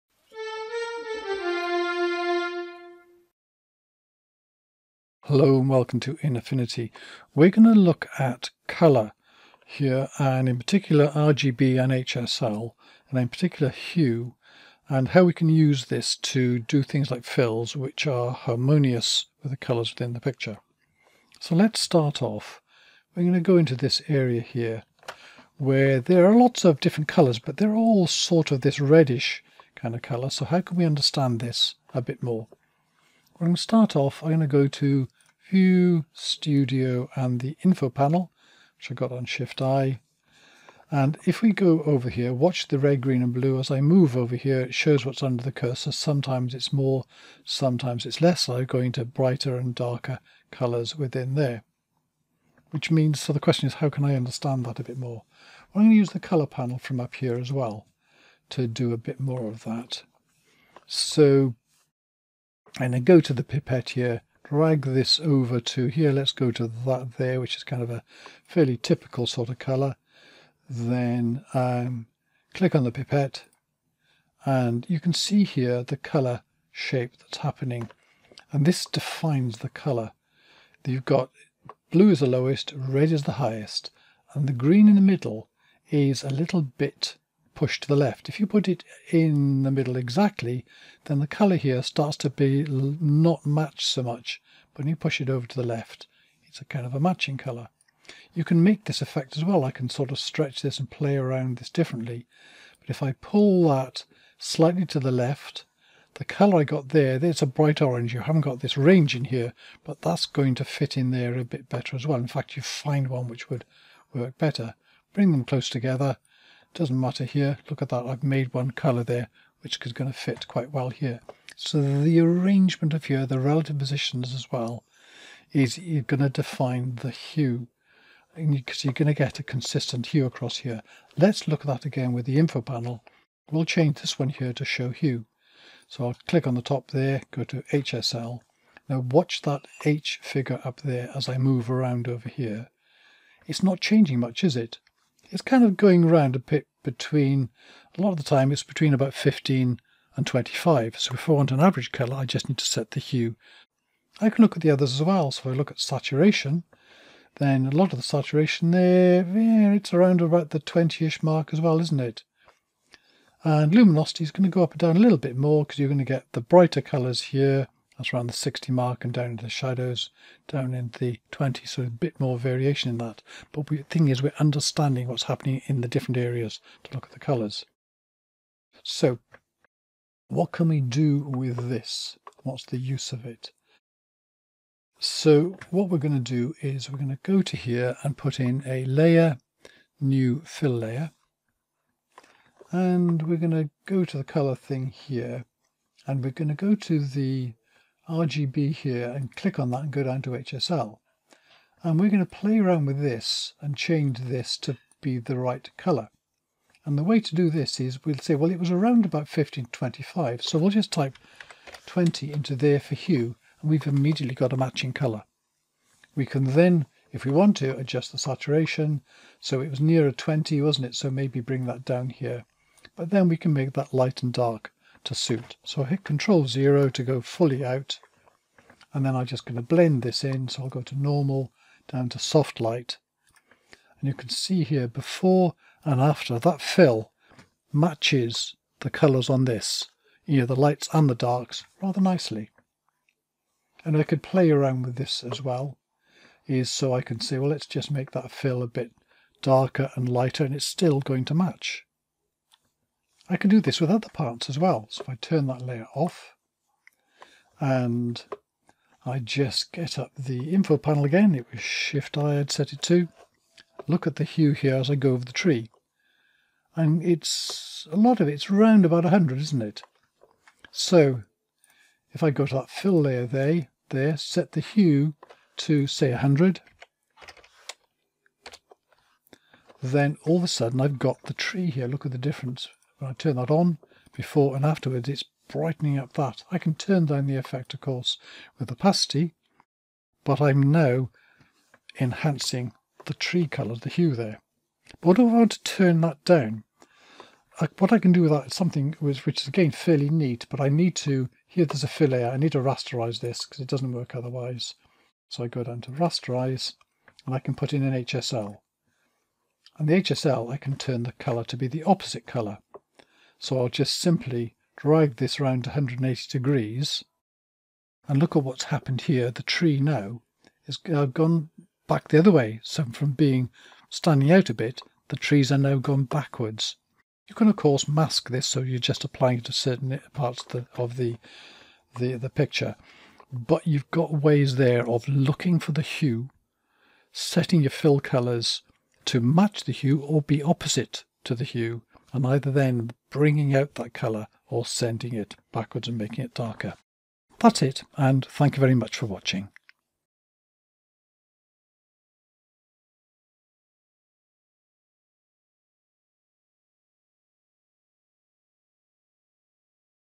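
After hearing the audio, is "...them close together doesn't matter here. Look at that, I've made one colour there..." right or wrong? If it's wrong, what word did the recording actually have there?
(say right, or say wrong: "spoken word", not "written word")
right.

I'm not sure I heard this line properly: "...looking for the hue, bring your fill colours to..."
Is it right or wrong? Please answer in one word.
wrong.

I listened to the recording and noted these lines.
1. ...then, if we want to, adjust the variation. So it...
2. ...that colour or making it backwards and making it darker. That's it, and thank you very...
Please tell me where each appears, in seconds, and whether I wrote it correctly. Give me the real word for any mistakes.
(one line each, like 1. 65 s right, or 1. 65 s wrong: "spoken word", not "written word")
1. 216 s wrong: "saturation", not "variation"
2. 343 s wrong: "sending", not "making".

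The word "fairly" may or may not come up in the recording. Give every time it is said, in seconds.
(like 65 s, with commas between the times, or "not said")
68 s, 299 s.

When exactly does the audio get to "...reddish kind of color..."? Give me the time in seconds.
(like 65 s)
28 s.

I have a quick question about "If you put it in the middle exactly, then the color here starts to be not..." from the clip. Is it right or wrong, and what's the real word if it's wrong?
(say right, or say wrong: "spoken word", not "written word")
right.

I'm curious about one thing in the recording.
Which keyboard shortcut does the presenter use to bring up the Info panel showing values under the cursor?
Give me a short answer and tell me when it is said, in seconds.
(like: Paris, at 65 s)
Shift-I, at 39 s.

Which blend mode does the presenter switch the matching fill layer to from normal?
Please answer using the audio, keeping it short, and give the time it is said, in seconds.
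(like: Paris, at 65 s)
Soft light, at 232 s.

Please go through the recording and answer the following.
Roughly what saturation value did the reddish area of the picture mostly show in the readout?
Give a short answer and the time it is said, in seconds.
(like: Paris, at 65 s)
20, at 160 s.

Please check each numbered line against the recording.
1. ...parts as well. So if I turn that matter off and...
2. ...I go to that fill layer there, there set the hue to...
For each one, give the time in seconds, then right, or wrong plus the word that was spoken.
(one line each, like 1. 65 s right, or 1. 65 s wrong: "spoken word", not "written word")
1. 254 s wrong: "layer", not "matter"
2. 272 s right.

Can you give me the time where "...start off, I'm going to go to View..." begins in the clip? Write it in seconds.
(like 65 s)
33 s.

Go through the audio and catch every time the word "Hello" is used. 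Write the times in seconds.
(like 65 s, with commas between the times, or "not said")
5 s.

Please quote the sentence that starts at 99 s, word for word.
I can sort of stretch this and play around this differently.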